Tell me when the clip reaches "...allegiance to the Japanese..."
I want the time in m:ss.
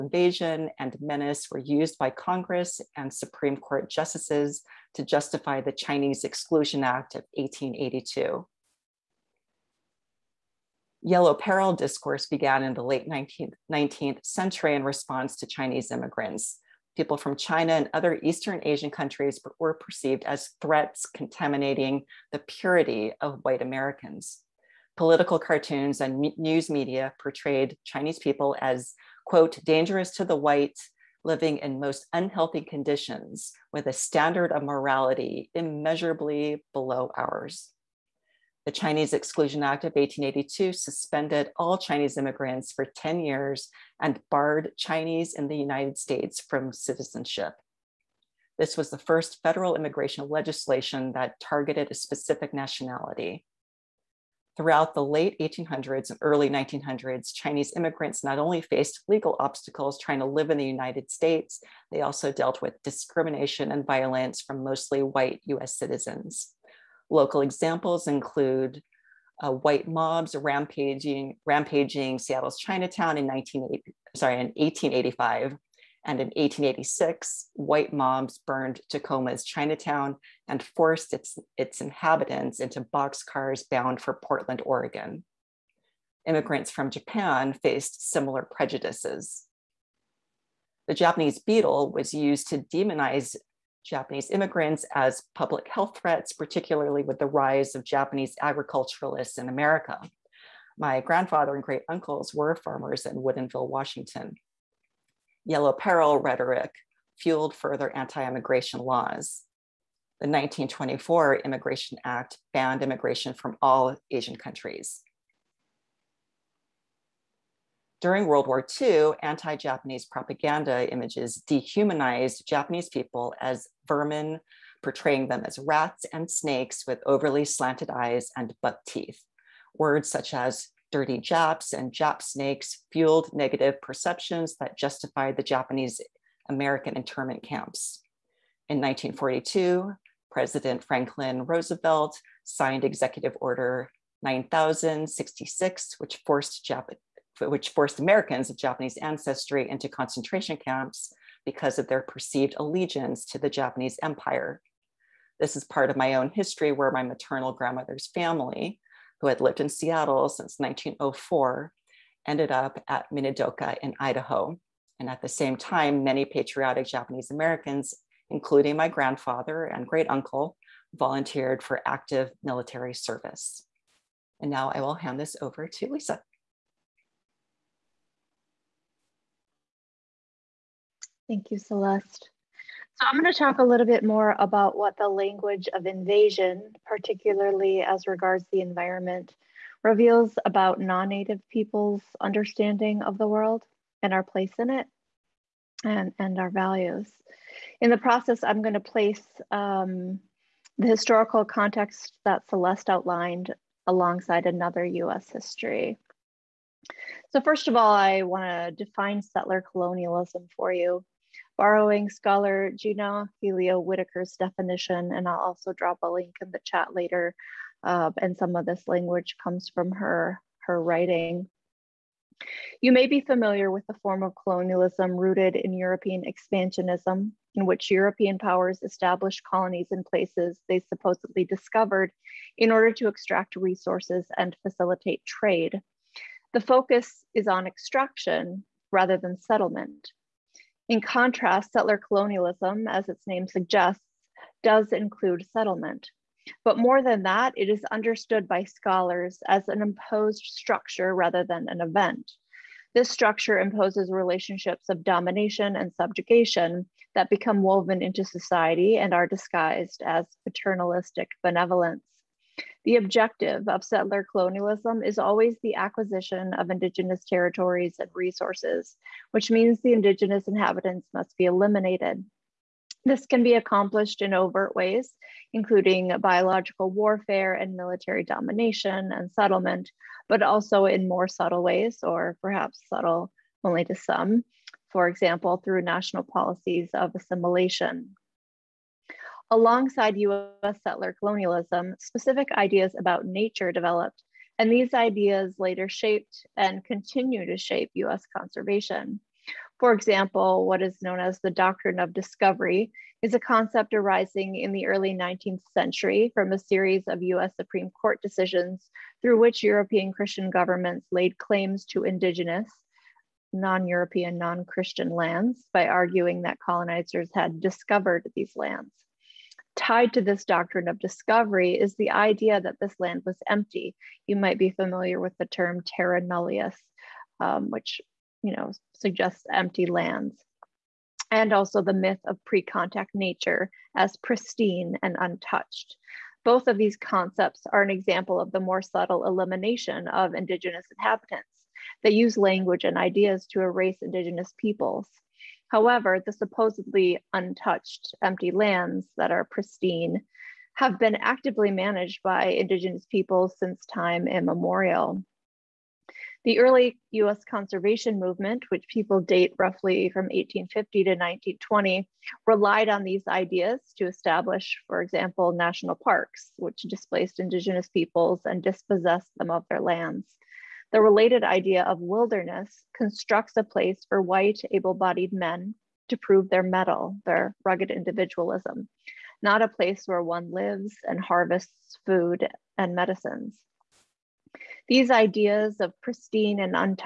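2:32.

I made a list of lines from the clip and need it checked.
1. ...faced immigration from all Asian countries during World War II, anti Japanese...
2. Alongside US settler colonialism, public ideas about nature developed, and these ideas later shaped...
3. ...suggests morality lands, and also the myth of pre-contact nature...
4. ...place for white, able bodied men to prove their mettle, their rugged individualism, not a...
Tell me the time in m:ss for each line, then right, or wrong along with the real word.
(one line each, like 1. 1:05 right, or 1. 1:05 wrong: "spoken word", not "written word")
1. 1:52 wrong: "banned", not "faced"
2. 4:49 wrong: "specific", not "public"
3. 5:28 wrong: "empty", not "morality"
4. 6:13 right.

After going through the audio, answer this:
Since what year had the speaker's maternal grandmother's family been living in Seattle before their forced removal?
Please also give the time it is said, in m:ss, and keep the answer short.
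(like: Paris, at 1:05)
1904, at 2:40.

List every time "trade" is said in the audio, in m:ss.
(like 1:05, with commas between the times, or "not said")
3:55.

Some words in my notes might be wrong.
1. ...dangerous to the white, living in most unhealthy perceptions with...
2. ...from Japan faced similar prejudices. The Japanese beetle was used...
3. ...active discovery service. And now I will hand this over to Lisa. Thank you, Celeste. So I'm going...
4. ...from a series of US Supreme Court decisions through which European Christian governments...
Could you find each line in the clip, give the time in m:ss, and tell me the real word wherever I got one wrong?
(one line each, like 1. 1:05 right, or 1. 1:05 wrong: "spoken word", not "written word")
1. 0:29 wrong: "conditions", not "perceptions"
2. 1:26 right
3. 2:51 wrong: "military", not "discovery"
4. 5:06 right.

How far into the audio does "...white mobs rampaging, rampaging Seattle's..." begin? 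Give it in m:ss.
1:09.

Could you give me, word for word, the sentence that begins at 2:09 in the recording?
Words such as dirty Japs and Jap snakes fueled negative perceptions that justified the Japanese American internment camps.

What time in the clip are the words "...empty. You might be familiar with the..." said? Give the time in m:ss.
5:23.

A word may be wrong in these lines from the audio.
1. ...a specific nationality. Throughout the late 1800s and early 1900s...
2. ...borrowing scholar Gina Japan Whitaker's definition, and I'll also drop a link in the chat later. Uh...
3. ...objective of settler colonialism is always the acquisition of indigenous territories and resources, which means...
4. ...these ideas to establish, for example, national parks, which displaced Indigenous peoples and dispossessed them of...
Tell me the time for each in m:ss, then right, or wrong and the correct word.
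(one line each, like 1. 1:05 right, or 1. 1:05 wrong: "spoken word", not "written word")
1. 0:51 right
2. 3:31 wrong: "Helio", not "Japan"
3. 4:22 right
4. 6:03 right.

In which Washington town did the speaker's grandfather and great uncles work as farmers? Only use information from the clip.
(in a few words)
Woodinville.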